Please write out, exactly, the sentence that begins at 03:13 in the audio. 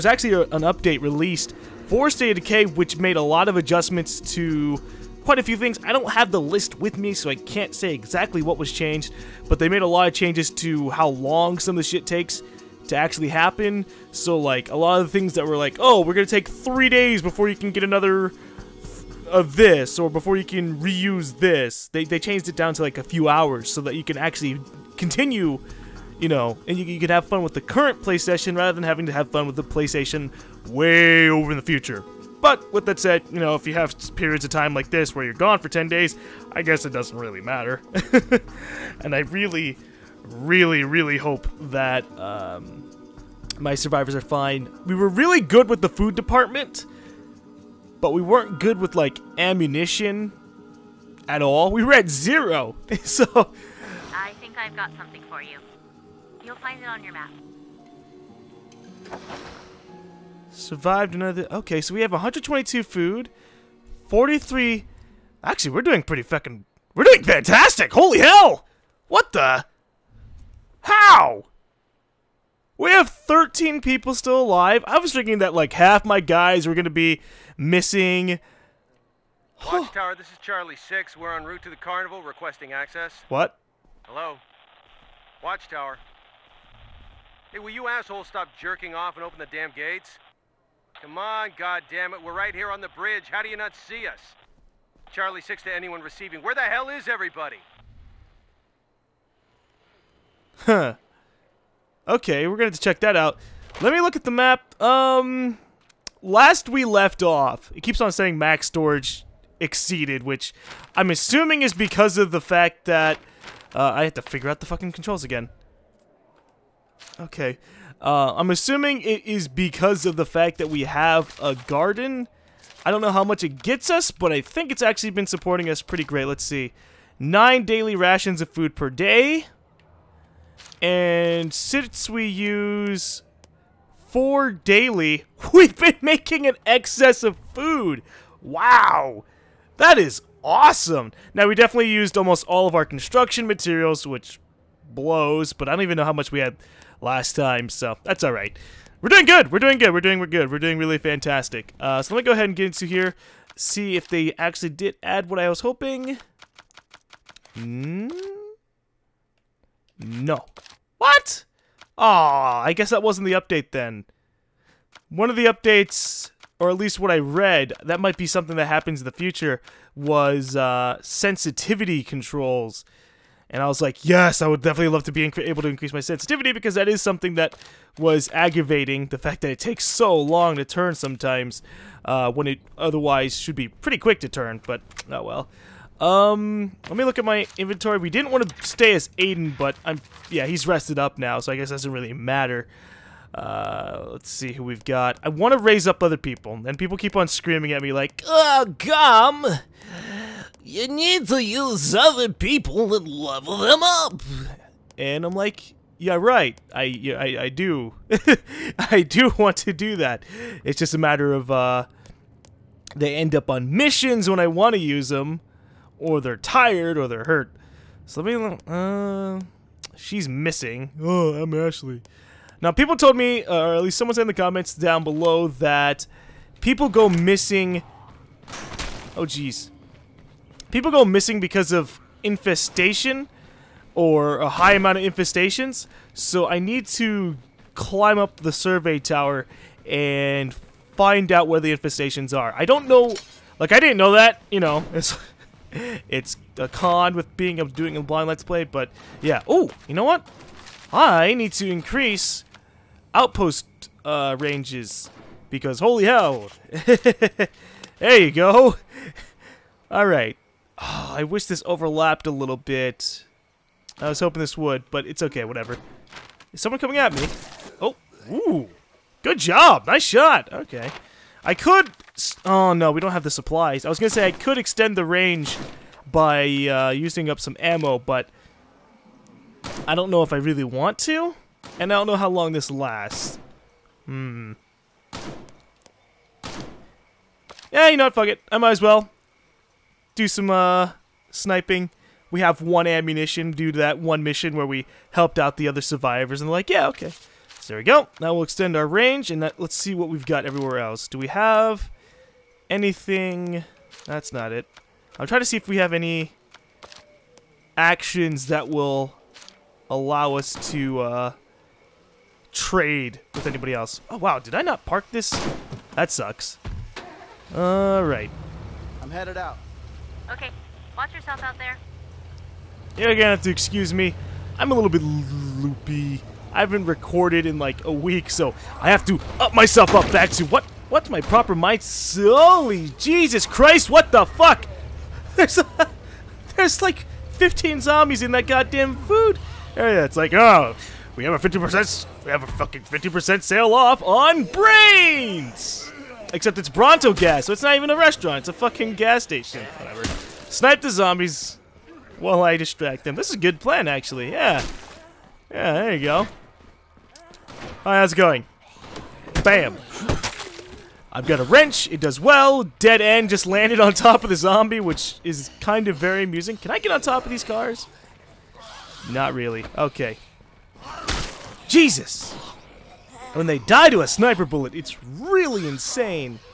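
Uh, let's see who we've got.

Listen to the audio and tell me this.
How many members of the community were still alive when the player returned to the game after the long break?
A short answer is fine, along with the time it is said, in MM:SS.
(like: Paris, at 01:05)
13, at 01:13.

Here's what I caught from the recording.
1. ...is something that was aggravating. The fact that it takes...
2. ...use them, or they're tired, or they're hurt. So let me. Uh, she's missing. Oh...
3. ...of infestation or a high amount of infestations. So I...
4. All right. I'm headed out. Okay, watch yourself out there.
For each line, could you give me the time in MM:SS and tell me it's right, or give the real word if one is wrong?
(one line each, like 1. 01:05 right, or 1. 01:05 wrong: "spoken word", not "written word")
1. 02:56 right
2. 03:34 right
3. 03:51 right
4. 05:17 right.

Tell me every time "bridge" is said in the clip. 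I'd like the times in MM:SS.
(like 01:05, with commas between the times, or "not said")
01:32.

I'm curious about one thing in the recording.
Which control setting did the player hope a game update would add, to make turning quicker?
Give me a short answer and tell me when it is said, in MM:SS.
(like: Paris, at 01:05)
sensitivity controls, at 02:51.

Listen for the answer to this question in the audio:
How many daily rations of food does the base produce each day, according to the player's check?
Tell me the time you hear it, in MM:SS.
02:07.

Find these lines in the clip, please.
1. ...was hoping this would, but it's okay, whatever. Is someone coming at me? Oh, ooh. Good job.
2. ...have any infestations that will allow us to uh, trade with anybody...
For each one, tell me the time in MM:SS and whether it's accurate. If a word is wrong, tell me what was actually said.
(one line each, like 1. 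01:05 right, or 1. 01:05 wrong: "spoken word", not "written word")
1. 04:24 right
2. 05:05 wrong: "actions", not "infestations".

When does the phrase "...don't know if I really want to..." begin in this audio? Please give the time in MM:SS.
04:39.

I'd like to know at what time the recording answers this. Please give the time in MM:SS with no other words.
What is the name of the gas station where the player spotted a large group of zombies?
05:46.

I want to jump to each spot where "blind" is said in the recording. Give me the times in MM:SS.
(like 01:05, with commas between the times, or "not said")
04:08.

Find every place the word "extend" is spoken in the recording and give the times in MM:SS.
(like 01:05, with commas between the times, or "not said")
04:34, 04:58.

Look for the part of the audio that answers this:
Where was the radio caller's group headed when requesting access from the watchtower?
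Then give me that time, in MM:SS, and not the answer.
01:21.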